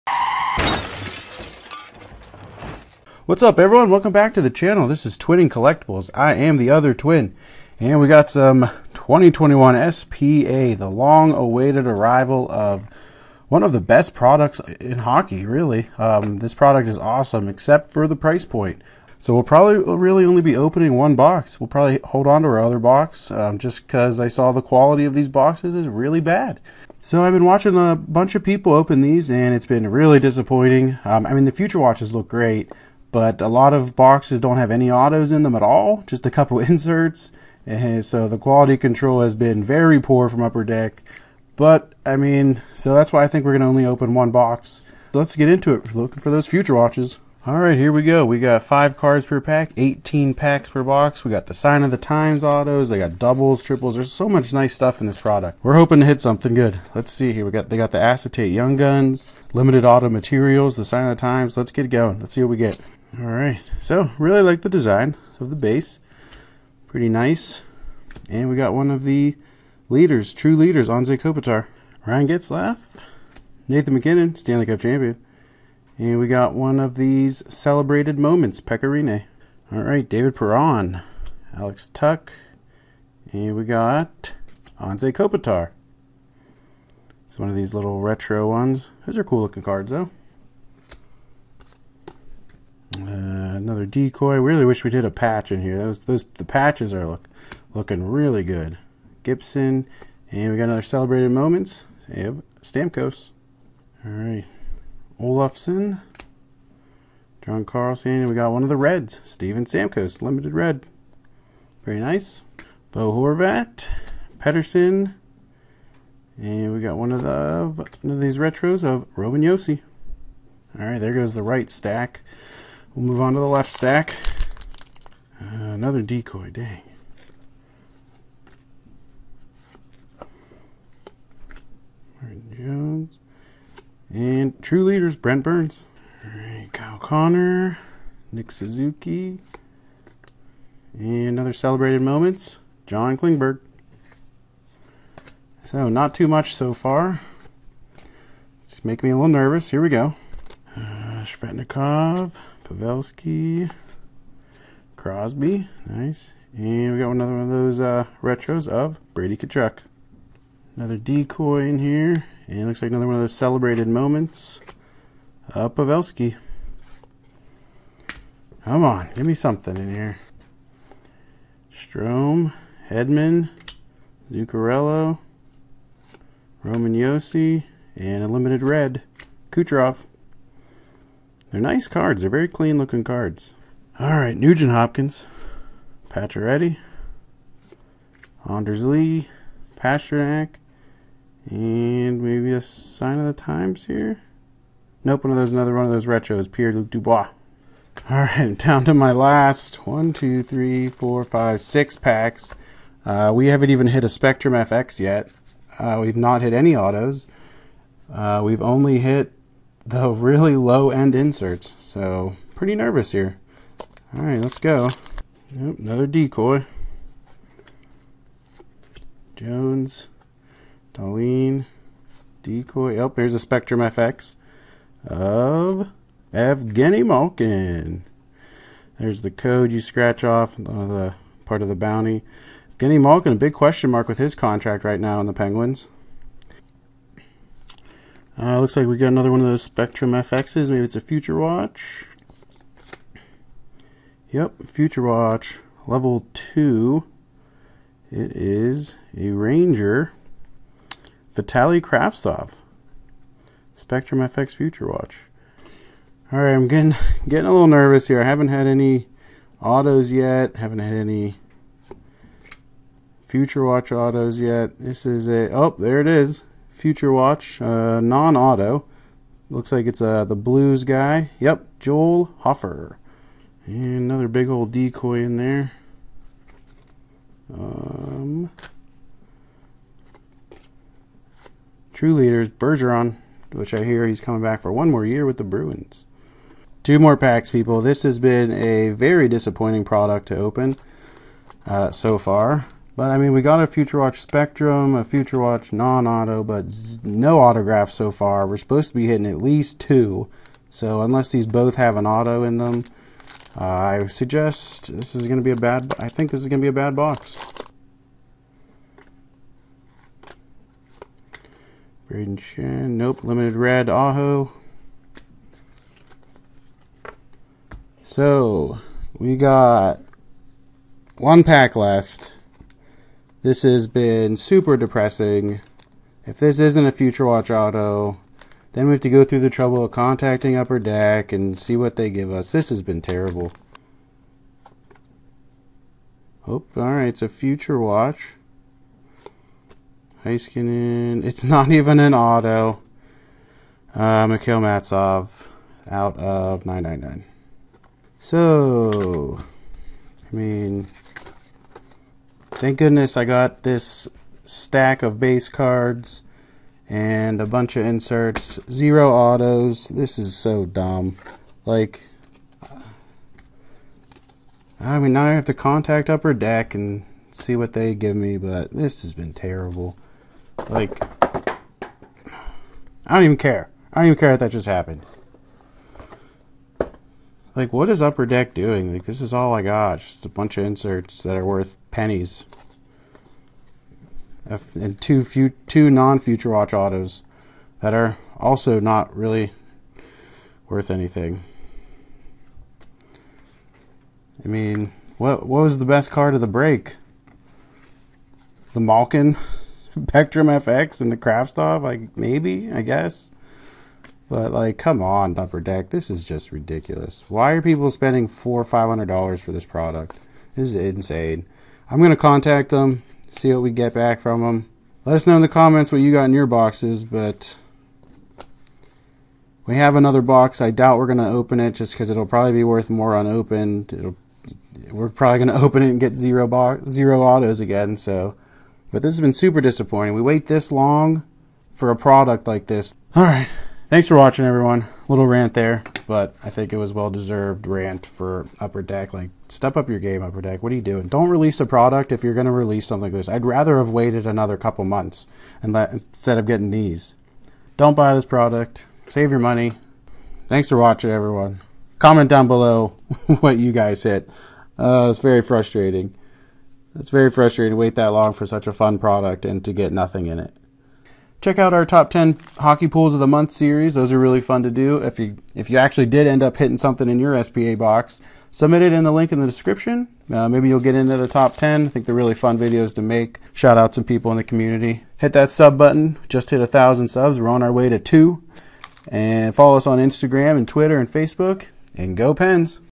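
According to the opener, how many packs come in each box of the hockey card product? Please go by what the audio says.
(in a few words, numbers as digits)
18.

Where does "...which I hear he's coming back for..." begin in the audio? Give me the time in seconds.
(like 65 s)
283 s.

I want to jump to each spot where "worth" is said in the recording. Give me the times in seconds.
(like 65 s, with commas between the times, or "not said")
381 s, 390 s, 422 s.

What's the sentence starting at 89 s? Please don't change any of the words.
Those are cool looking cards, though.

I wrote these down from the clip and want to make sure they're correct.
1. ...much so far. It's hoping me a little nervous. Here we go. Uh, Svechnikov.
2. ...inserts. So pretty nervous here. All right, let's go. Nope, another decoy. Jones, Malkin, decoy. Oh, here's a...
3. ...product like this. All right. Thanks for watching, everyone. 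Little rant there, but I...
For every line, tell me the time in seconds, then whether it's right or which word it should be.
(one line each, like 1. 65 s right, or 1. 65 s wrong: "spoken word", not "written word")
1. 146 s wrong: "making", not "hoping"
2. 211 s wrong: "Darlene", not "Malkin"
3. 431 s right.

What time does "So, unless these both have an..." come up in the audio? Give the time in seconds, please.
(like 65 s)
300 s.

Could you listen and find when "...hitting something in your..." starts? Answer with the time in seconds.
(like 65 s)
466 s.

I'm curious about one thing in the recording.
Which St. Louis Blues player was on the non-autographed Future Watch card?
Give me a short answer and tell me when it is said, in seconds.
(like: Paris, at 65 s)
Joel Hofer, at 271 s.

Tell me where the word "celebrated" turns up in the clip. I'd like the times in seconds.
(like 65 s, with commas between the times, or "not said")
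77 s, 100 s, 141 s, 163 s.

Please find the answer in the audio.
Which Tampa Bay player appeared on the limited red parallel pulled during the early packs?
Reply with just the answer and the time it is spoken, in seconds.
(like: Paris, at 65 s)
Steven Stamkos, at 109 s.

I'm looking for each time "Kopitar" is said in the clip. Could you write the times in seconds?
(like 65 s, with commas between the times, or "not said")
71 s, 85 s.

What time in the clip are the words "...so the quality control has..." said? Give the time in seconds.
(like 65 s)
38 s.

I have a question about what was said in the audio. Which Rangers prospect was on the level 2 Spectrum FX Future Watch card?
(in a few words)
Vitali Kravtsov.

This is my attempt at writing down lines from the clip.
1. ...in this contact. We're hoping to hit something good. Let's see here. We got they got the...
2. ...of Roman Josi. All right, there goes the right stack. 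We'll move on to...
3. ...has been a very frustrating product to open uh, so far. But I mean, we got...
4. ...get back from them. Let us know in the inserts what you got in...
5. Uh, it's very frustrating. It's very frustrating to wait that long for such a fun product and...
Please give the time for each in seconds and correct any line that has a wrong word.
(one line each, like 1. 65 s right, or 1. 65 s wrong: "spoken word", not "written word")
1. 55 s wrong: "product", not "contact"
2. 118 s right
3. 288 s wrong: "disappointing", not "frustrating"
4. 413 s wrong: "comments", not "inserts"
5. 454 s right.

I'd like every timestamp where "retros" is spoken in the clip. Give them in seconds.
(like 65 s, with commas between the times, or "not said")
88 s, 118 s, 158 s, 196 s.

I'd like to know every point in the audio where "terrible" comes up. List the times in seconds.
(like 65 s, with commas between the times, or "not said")
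333 s, 369 s.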